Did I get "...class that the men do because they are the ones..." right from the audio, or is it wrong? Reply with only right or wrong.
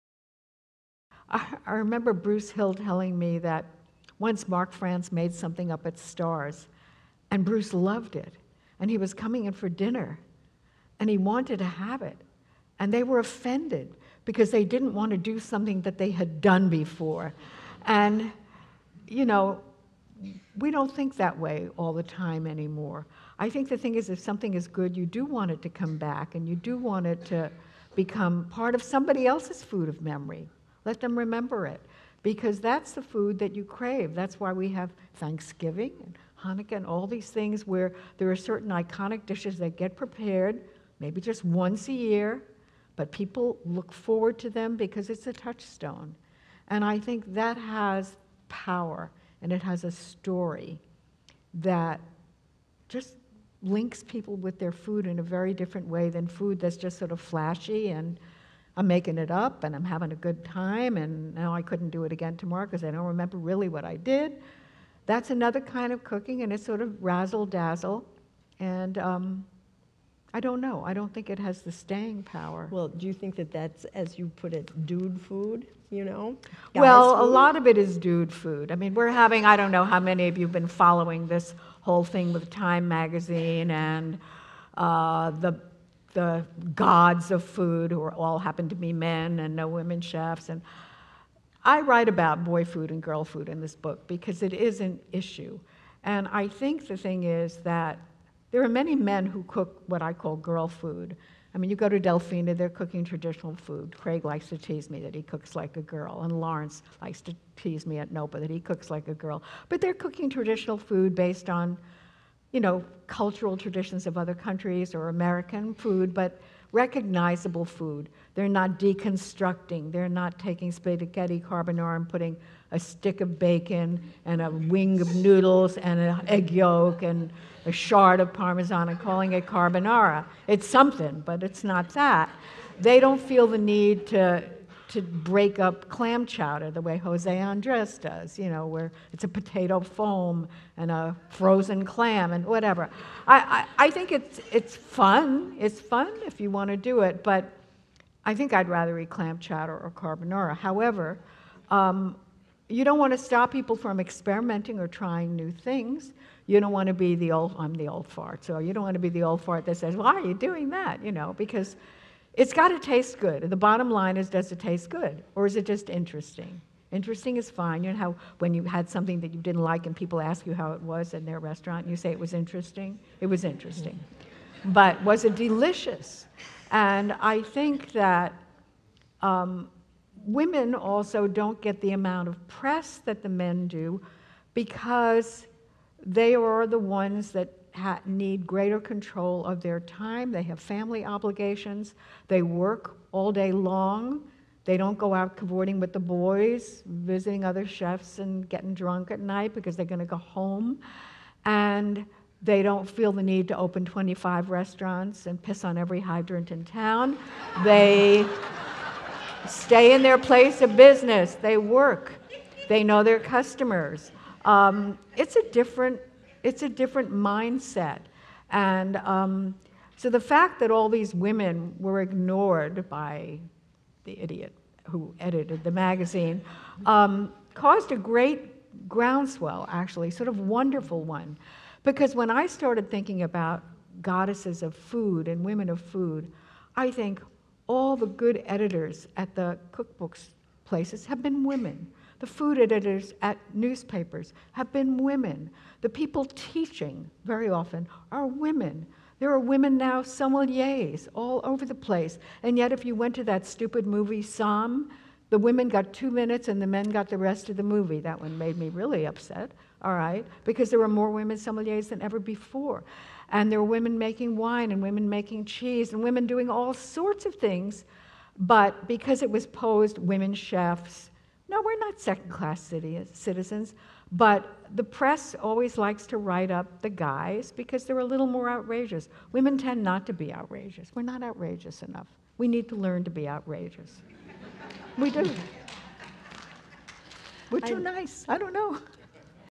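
wrong.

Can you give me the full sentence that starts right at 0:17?
And, you know, we don't think that way all the time anymore.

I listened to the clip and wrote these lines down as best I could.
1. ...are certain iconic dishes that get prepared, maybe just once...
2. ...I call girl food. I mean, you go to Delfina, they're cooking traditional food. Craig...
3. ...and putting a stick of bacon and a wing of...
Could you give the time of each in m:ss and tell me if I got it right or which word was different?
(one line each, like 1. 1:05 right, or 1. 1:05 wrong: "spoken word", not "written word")
1. 0:38 right
2. 1:40 right
3. 2:01 right.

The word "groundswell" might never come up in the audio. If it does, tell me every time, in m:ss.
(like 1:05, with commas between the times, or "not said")
3:48.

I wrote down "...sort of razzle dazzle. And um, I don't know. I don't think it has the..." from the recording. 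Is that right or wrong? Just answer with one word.
right.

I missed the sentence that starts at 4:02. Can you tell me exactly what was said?
The food editors at newspapers have been women.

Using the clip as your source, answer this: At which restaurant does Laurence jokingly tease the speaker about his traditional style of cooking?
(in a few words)
NOPA.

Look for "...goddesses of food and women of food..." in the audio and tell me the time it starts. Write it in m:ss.
3:54.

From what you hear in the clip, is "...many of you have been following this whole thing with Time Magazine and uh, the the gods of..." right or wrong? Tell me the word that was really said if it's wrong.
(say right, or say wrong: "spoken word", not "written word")
right.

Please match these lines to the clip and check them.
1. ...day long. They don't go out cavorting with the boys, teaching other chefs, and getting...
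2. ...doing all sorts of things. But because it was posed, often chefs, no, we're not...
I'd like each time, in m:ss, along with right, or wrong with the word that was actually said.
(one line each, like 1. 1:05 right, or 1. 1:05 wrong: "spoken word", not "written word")
1. 3:13 wrong: "visiting", not "teaching"
2. 4:26 wrong: "women", not "often".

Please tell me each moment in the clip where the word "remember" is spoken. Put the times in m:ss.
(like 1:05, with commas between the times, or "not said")
0:01, 0:31, 1:03.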